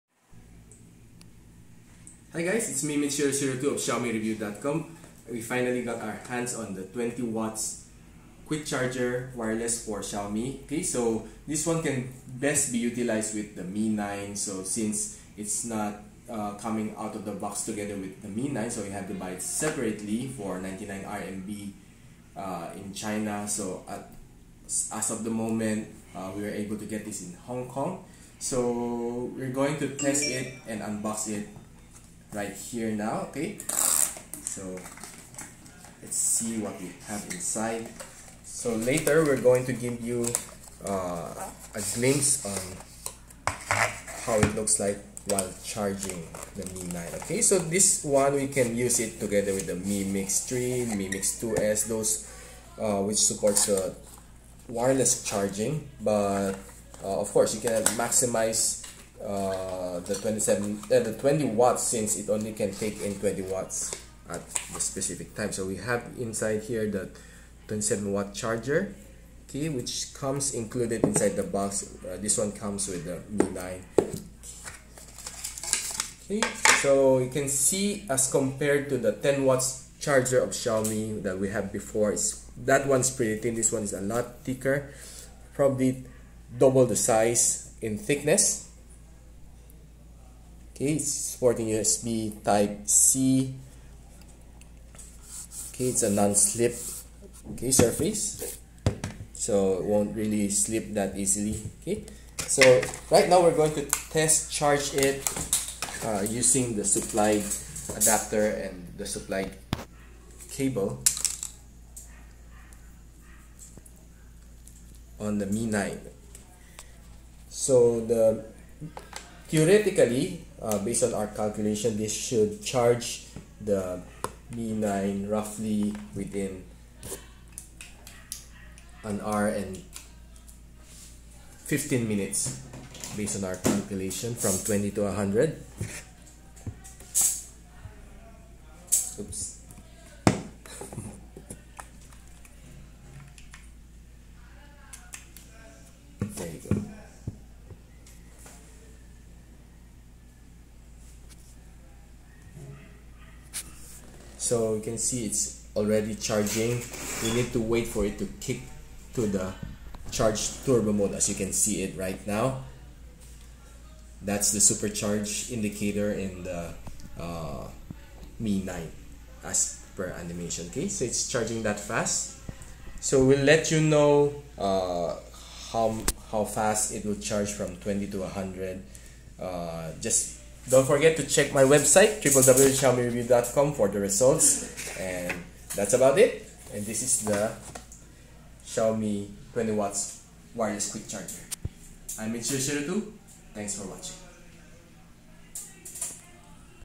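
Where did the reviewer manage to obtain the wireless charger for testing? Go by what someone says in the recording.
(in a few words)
Hong Kong.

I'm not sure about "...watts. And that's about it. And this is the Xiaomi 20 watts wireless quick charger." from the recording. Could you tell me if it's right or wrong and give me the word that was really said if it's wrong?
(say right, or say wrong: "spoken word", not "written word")
wrong: "results", not "watts".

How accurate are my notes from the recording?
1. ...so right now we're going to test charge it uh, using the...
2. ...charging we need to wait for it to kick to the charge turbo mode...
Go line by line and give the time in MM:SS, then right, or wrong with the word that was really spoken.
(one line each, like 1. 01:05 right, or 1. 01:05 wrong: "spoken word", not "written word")
1. 01:42 right
2. 02:36 right.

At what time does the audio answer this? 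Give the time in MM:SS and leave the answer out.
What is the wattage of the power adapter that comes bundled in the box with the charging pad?
01:07.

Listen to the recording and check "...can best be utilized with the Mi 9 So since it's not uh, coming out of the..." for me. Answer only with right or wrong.
right.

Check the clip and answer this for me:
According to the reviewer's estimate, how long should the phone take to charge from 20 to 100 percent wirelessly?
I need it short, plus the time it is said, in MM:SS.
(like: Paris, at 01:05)
an hour and 15 minutes, at 02:09.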